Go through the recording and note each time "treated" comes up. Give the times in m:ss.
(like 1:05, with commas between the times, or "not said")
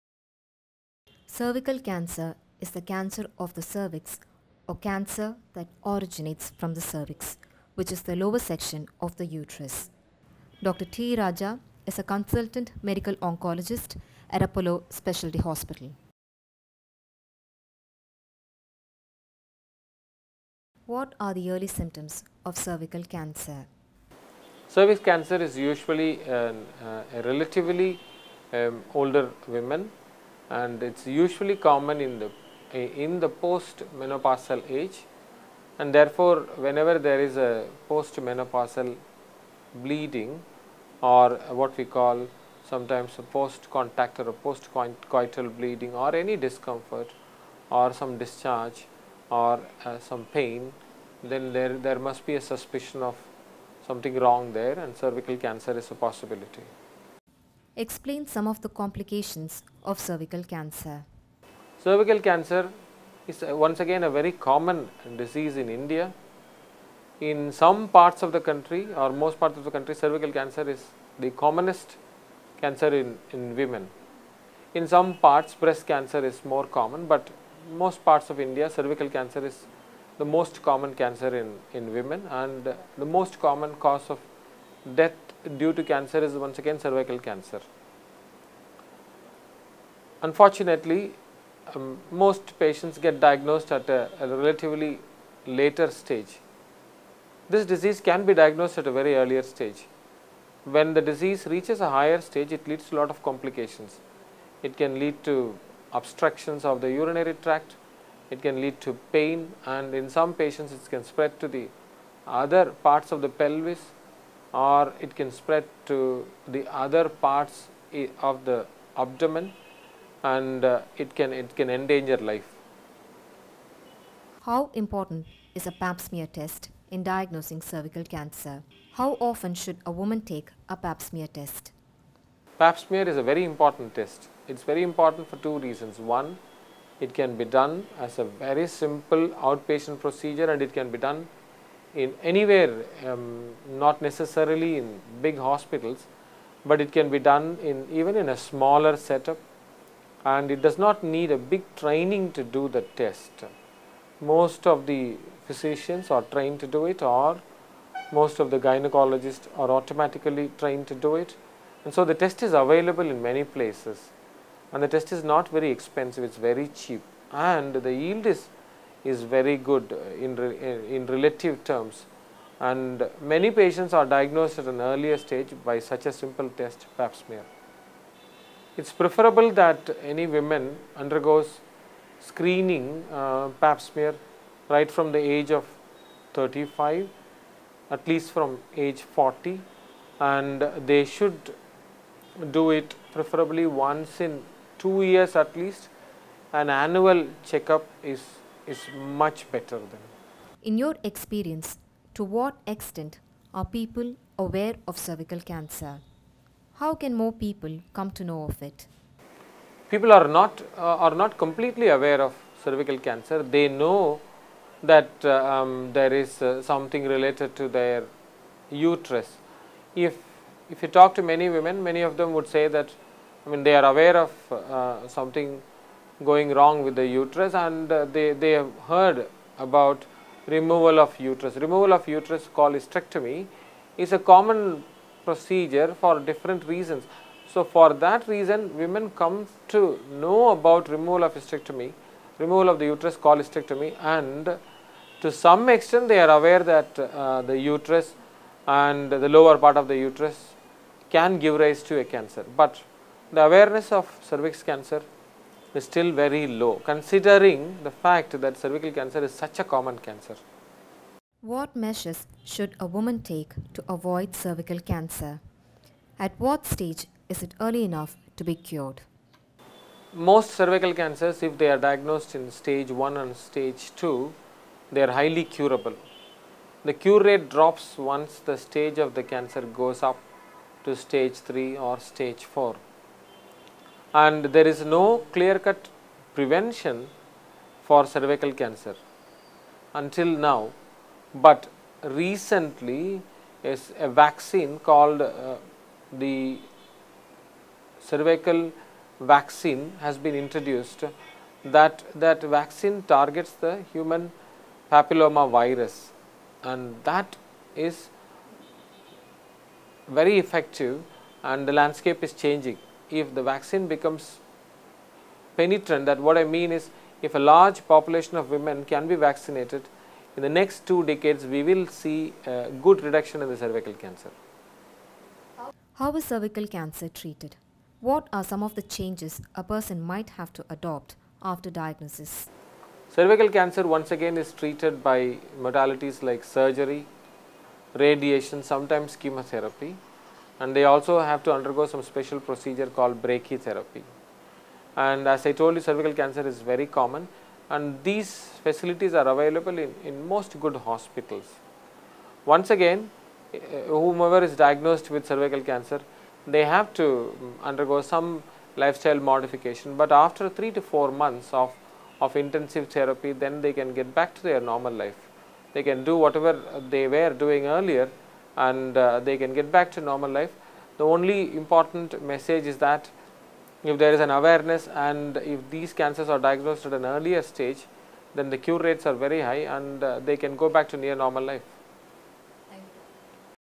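5:27, 5:34.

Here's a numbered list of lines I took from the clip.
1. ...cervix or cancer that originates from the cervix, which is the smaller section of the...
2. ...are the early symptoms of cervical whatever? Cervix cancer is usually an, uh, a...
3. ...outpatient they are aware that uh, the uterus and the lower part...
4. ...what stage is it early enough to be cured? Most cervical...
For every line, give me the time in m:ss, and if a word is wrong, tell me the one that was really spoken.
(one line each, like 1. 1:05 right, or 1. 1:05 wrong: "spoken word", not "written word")
1. 0:03 wrong: "lower", not "smaller"
2. 0:21 wrong: "cancer", not "whatever"
3. 4:05 wrong: "extent", not "outpatient"
4. 4:26 right.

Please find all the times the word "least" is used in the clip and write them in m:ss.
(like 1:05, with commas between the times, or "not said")
3:08, 3:15.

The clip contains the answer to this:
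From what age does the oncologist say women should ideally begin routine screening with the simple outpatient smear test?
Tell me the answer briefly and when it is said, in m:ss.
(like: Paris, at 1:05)
35, at 3:06.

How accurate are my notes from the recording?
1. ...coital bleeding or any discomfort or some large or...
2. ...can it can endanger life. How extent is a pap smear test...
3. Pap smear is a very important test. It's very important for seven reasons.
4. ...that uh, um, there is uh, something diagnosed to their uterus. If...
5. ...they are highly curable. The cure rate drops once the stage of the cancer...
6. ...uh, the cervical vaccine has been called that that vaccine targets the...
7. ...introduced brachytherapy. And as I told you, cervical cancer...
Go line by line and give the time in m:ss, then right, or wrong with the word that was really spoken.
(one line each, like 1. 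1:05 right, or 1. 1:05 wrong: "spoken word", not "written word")
1. 0:45 wrong: "discharge", not "large"
2. 2:01 wrong: "important", not "extent"
3. 2:12 wrong: "two", not "seven"
4. 3:34 wrong: "related", not "diagnosed"
5. 4:34 right
6. 4:55 wrong: "introduced", not "called"
7. 5:42 wrong: "called", not "introduced".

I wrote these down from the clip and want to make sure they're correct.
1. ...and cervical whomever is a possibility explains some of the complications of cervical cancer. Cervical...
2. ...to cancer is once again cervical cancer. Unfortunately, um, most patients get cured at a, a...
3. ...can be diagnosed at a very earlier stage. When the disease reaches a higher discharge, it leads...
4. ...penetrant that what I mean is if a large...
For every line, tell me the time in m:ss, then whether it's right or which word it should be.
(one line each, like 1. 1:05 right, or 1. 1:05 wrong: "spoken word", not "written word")
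1. 0:54 wrong: "cancer", not "whomever"
2. 1:25 wrong: "diagnosed", not "cured"
3. 1:38 wrong: "stage", not "discharge"
4. 5:15 right.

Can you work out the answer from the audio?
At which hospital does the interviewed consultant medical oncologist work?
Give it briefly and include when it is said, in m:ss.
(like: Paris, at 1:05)
Apollo Specialty Hospital, at 0:14.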